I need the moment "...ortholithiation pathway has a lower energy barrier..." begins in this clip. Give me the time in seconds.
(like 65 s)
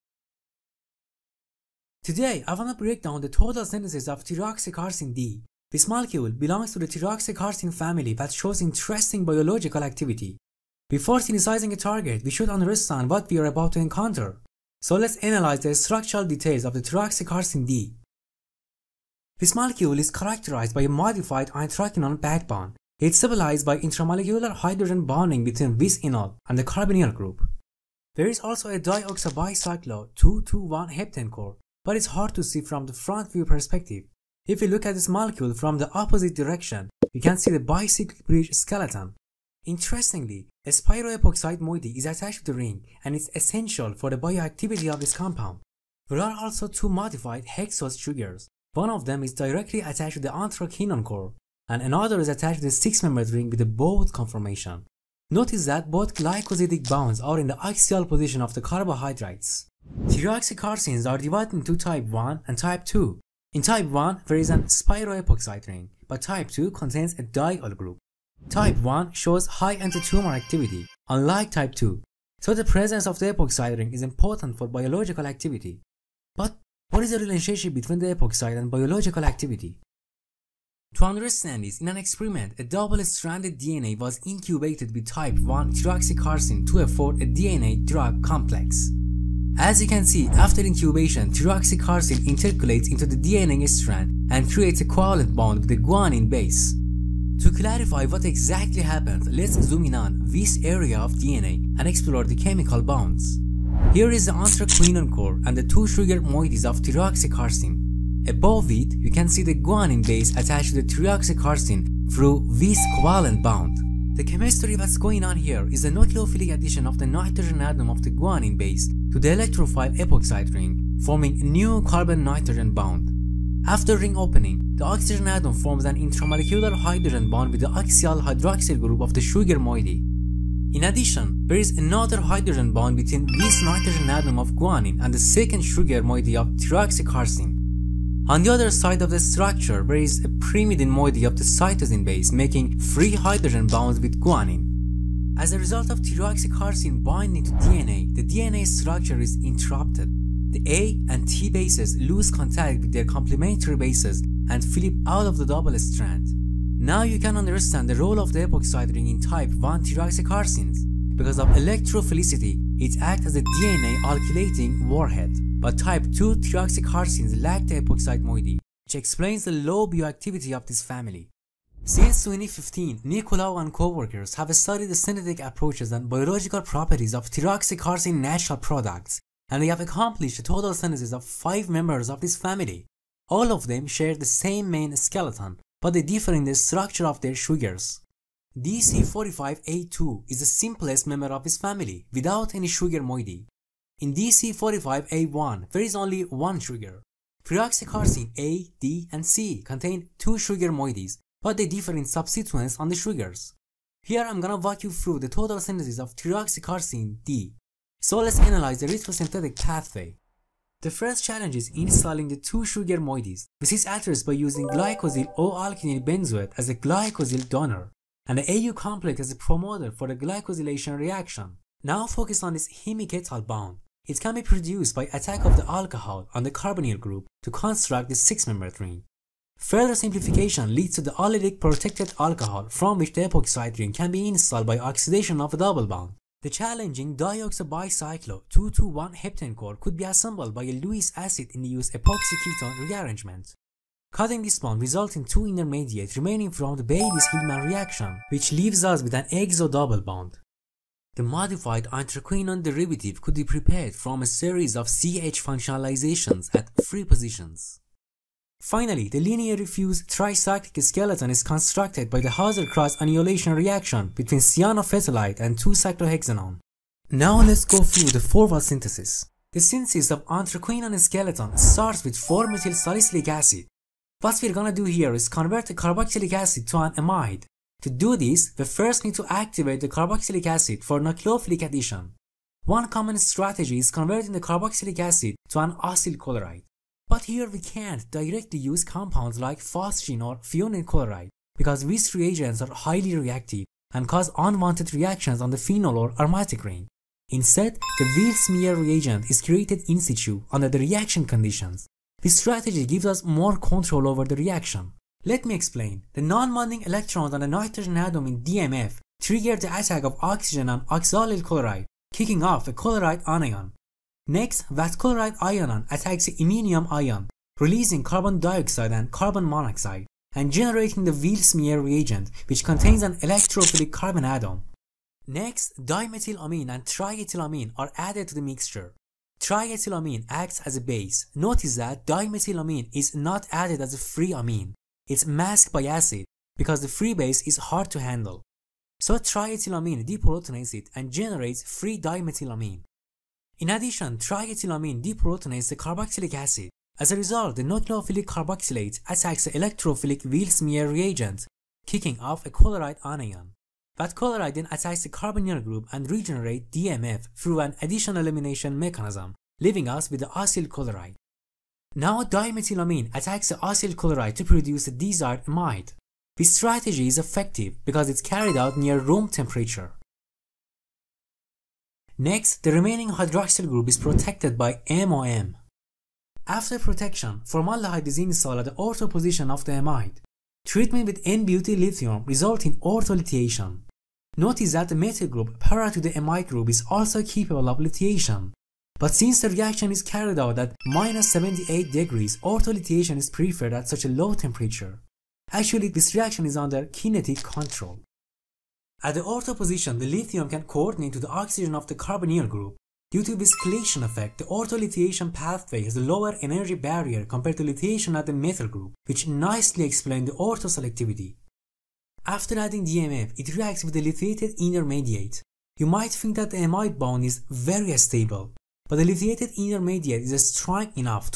404 s.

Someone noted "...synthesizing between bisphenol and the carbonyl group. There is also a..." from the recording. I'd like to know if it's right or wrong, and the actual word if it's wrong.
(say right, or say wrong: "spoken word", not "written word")
wrong: "bonding", not "synthesizing".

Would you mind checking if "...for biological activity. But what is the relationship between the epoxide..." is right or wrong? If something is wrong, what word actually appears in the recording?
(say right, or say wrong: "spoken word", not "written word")
right.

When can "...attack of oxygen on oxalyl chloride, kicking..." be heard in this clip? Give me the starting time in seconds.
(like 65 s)
309 s.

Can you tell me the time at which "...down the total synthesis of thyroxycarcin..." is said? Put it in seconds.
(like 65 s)
2 s.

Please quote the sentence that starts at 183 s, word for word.
All of them share the same main skeleton, but they differ in the structure of their sugars.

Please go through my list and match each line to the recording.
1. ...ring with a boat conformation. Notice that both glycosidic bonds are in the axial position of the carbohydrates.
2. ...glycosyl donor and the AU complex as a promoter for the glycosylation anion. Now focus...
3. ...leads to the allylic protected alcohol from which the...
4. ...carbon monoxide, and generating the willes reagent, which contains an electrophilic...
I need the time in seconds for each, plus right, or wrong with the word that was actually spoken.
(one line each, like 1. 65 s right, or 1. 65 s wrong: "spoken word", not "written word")
1. 53 s right
2. 216 s wrong: "reaction", not "anion"
3. 230 s right
4. 319 s right.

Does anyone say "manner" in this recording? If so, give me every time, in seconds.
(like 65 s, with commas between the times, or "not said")
not said.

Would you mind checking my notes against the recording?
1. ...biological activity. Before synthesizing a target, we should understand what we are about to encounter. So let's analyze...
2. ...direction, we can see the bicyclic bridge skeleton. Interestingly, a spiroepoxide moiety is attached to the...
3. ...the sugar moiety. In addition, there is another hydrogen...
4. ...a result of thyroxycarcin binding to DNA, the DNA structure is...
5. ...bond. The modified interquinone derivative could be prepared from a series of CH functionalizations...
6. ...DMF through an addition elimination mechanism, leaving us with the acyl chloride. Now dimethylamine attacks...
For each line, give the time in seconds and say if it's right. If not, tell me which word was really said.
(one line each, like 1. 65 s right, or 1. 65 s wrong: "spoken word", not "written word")
1. 9 s right
2. 36 s right
3. 129 s right
4. 145 s right
5. 250 s right
6. 356 s right.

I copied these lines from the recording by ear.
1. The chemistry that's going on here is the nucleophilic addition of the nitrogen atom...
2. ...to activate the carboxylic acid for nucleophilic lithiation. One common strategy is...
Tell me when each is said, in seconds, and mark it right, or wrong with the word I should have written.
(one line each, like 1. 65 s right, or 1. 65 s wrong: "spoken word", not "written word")
1. 114 s right
2. 279 s wrong: "addition", not "lithiation".